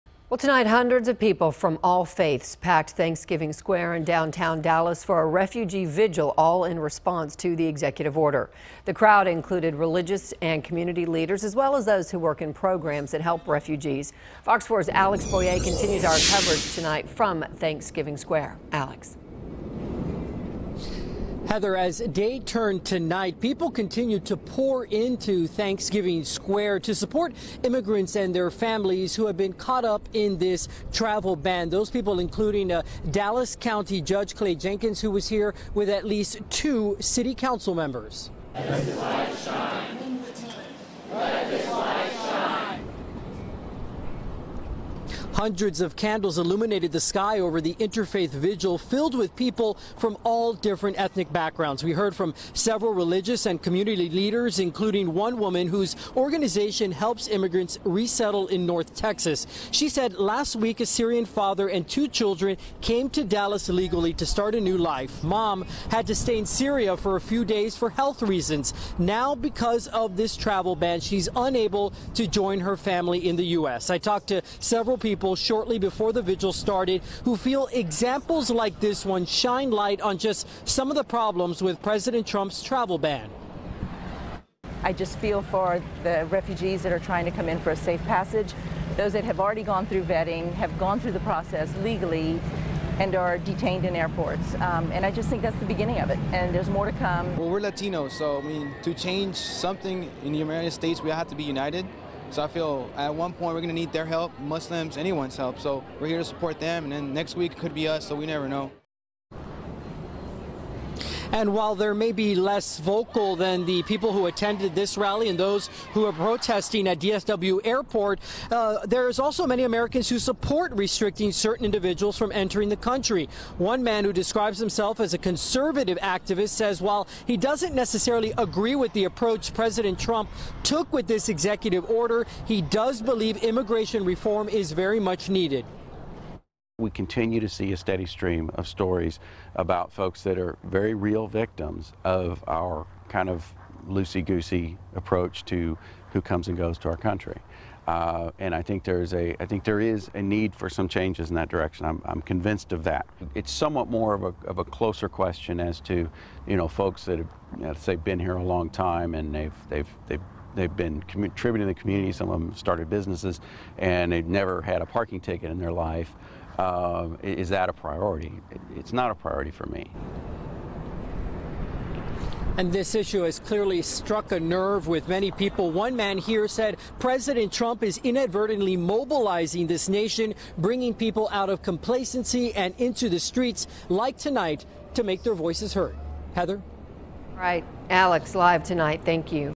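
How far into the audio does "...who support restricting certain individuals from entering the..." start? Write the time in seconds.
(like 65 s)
120 s.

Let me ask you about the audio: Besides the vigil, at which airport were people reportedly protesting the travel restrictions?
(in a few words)
DFW Airport.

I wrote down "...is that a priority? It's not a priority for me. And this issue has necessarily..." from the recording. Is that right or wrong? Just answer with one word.
wrong.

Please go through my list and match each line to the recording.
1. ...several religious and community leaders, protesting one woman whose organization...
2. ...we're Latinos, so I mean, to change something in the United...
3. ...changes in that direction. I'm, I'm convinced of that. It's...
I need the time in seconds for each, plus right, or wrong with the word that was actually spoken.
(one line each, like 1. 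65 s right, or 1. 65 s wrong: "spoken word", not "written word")
1. 52 s wrong: "including", not "protesting"
2. 97 s right
3. 150 s right.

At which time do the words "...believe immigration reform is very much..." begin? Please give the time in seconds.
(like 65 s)
133 s.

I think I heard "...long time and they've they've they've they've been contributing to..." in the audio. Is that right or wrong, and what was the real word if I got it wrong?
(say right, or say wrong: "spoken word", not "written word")
right.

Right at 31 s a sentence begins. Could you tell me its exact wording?
Those people including uh, Dallas County Judge Clay Jenkins, who was here with at least two city council members.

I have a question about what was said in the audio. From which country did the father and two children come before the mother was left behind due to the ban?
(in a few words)
Syria.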